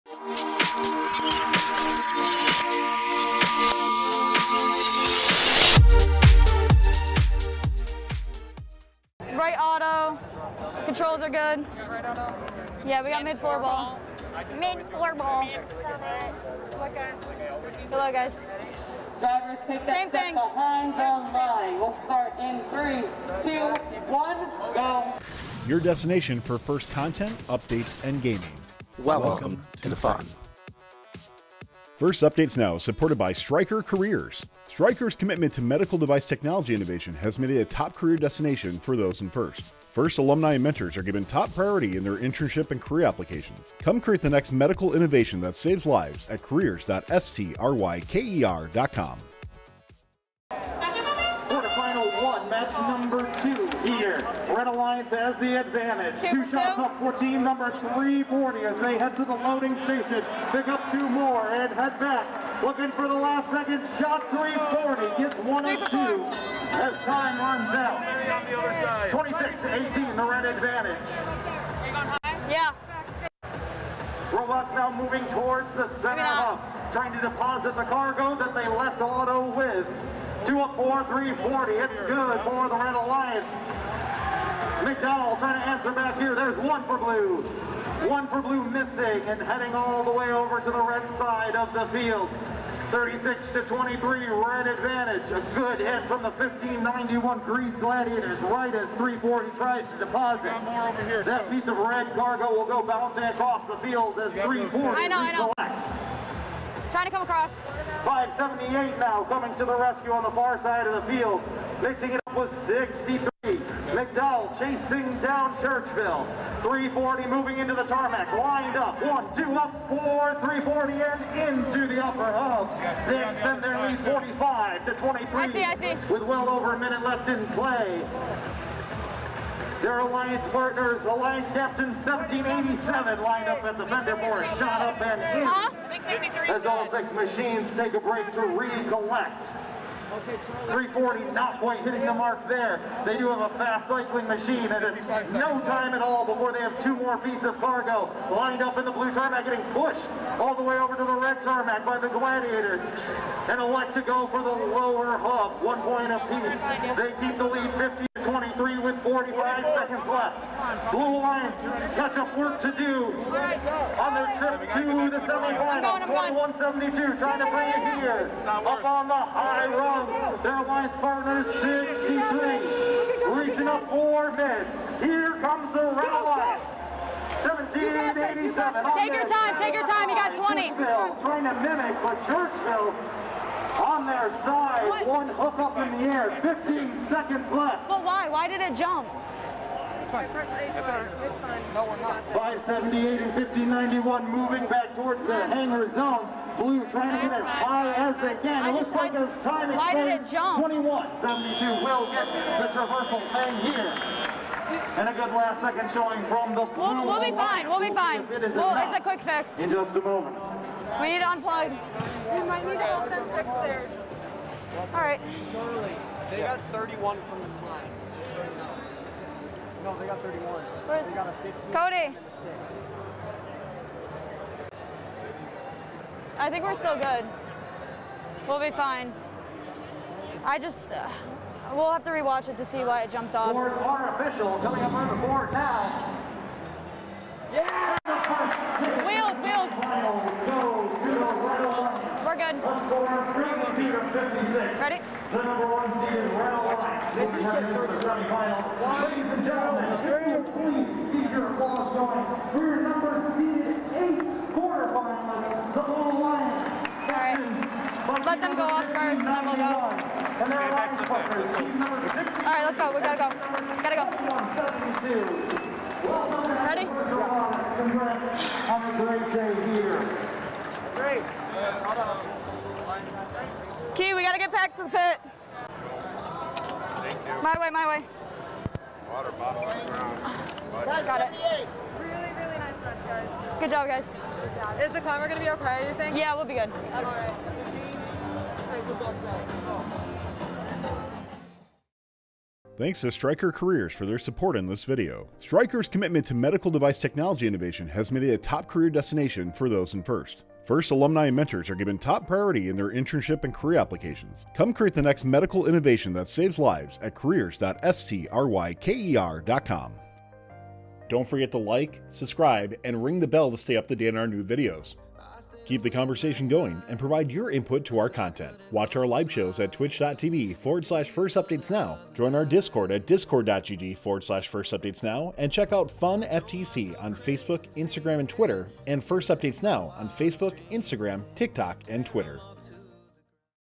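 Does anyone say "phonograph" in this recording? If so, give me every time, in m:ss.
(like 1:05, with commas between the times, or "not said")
not said.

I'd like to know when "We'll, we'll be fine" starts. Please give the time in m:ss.
3:26.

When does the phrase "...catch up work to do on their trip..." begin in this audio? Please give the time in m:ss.
2:41.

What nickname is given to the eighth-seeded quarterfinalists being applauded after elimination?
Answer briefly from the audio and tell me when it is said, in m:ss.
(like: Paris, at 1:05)
Little Lions, at 4:15.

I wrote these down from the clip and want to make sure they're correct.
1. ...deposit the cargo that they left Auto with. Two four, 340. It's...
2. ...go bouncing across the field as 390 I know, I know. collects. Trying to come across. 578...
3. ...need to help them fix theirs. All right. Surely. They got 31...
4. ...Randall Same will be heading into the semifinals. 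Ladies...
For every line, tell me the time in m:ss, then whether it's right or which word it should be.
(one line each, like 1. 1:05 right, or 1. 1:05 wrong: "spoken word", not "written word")
1. 1:17 right
2. 1:42 wrong: "340", not "390"
3. 3:32 right
4. 4:06 wrong: "Lines", not "Same".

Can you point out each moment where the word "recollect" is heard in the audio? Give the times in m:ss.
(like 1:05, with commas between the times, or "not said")
2:18.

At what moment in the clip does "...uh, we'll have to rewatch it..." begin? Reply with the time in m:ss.
3:50.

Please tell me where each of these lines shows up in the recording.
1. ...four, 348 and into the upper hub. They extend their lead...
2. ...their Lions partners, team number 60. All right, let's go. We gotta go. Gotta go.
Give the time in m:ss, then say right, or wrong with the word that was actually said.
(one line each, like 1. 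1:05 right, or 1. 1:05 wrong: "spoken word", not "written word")
1. 1:59 wrong: "340", not "348"
2. 4:20 right.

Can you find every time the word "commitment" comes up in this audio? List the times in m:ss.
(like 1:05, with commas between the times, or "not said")
0:35, 4:55.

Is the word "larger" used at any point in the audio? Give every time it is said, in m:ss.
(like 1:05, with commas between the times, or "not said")
not said.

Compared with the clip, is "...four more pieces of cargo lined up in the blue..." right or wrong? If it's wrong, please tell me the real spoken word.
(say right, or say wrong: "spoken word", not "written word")
wrong: "two", not "four".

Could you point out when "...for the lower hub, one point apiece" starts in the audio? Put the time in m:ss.
2:34.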